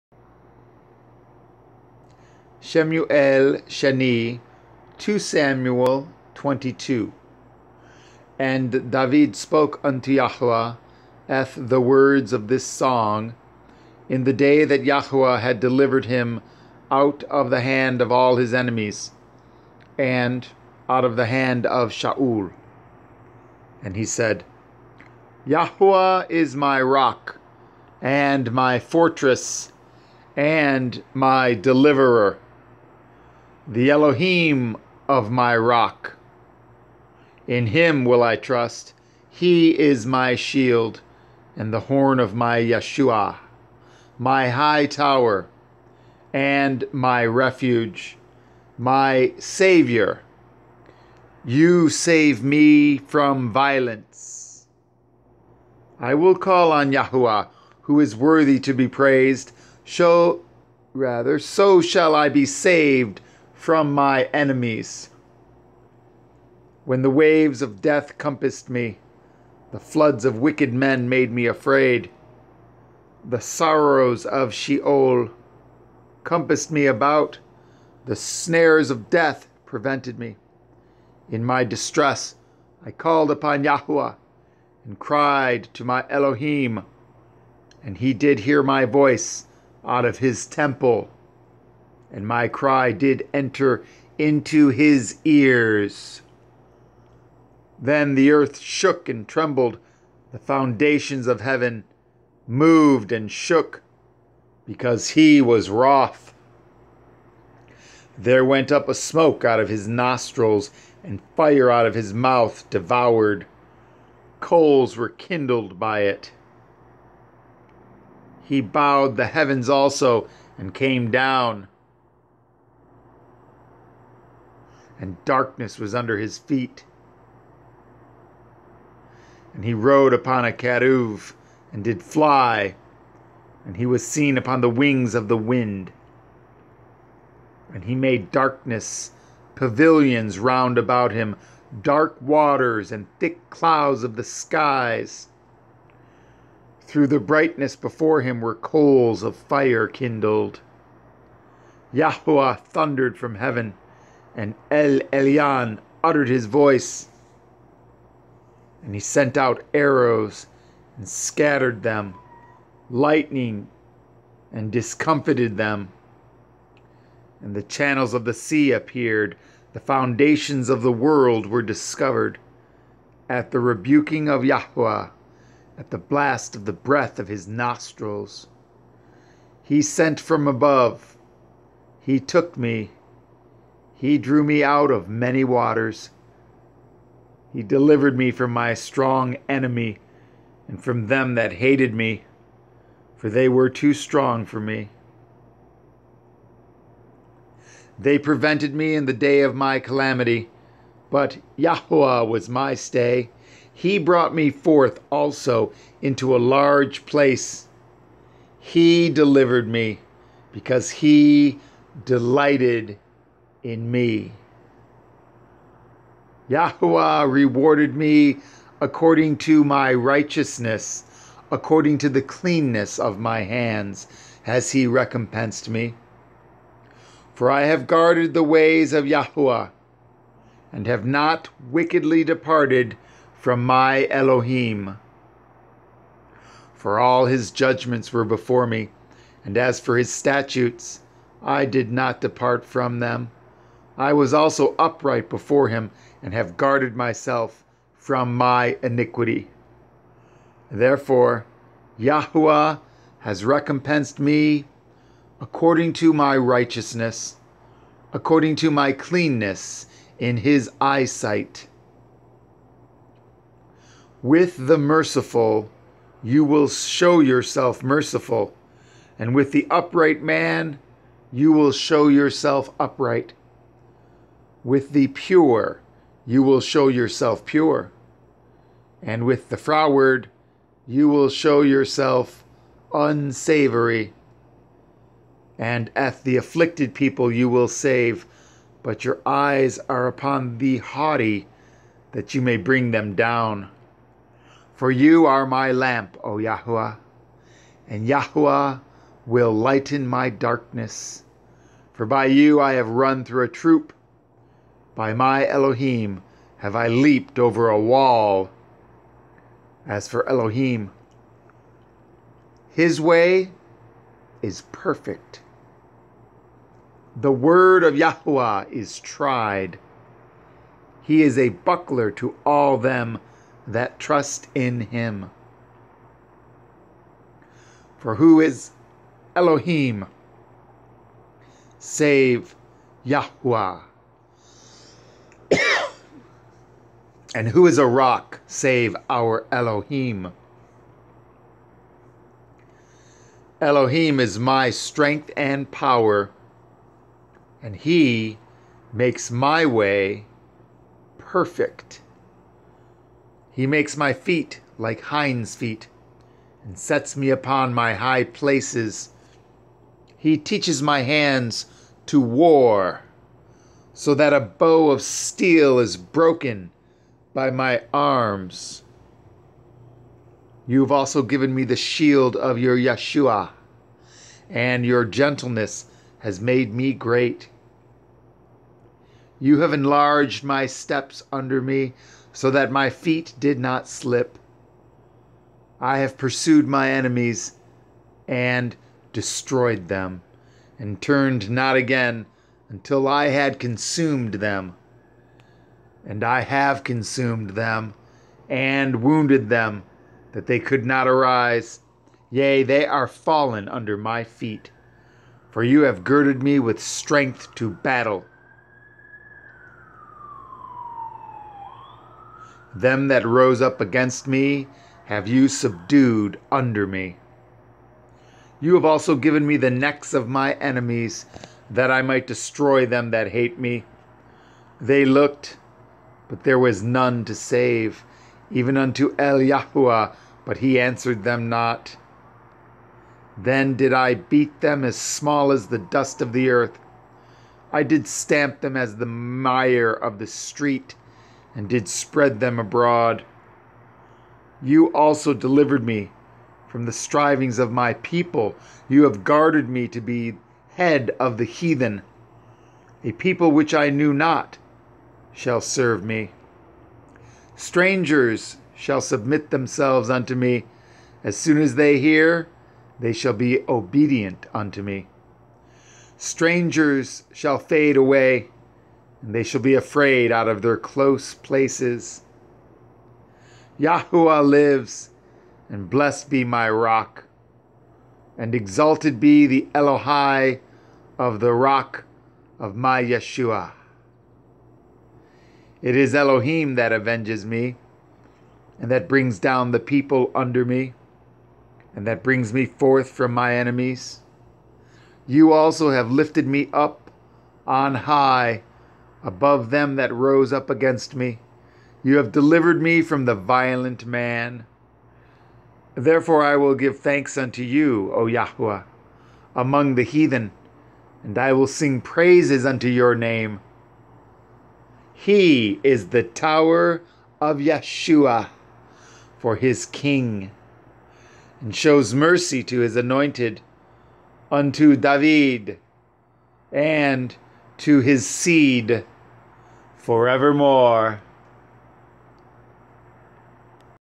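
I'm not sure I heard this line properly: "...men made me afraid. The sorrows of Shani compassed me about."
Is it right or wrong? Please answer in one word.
wrong.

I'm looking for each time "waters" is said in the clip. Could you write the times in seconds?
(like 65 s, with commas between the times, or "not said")
142 s, 185 s.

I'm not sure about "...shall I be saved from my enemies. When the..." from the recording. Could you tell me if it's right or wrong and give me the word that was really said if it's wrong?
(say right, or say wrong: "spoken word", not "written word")
right.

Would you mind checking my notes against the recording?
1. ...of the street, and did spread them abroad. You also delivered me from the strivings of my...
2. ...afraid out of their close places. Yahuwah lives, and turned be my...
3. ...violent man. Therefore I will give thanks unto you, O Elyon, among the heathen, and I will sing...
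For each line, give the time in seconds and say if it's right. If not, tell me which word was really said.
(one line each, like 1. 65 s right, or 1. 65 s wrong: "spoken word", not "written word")
1. 439 s right
2. 469 s wrong: "blessed", not "turned"
3. 503 s wrong: "Yahweh", not "Elyon".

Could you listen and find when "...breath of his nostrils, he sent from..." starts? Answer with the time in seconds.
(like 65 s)
176 s.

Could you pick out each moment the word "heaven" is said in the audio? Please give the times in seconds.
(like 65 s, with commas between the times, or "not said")
101 s, 119 s, 153 s.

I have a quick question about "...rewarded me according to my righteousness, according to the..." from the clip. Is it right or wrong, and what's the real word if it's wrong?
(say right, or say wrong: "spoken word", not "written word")
right.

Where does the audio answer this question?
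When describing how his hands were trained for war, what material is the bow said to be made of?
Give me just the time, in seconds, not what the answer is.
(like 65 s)
365 s.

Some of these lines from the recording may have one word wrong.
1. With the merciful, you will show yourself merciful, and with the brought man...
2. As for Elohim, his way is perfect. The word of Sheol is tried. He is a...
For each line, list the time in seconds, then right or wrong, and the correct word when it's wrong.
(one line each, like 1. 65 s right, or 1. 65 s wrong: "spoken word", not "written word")
1. 264 s wrong: "upright", not "brought"
2. 309 s wrong: "Yahweh", not "Sheol".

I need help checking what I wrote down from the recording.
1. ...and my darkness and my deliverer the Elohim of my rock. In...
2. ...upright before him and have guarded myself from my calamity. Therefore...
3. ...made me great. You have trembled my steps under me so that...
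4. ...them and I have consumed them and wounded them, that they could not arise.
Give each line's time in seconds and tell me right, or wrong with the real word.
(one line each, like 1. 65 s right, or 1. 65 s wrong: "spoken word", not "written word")
1. 28 s wrong: "fortress", not "darkness"
2. 244 s wrong: "iniquity", not "calamity"
3. 376 s wrong: "enlarged", not "trembled"
4. 394 s right.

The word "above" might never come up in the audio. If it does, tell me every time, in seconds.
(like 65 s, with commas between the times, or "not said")
180 s, 499 s.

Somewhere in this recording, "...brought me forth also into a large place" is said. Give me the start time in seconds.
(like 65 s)
203 s.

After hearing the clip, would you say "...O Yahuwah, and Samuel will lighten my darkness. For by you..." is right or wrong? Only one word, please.
wrong.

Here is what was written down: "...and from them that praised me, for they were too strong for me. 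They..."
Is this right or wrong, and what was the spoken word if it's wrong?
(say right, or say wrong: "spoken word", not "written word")
wrong: "hated", not "praised".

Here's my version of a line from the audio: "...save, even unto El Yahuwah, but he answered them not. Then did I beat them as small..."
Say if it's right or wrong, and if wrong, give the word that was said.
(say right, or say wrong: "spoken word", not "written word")
right.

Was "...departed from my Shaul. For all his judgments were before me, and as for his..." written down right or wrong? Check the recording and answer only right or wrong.
wrong.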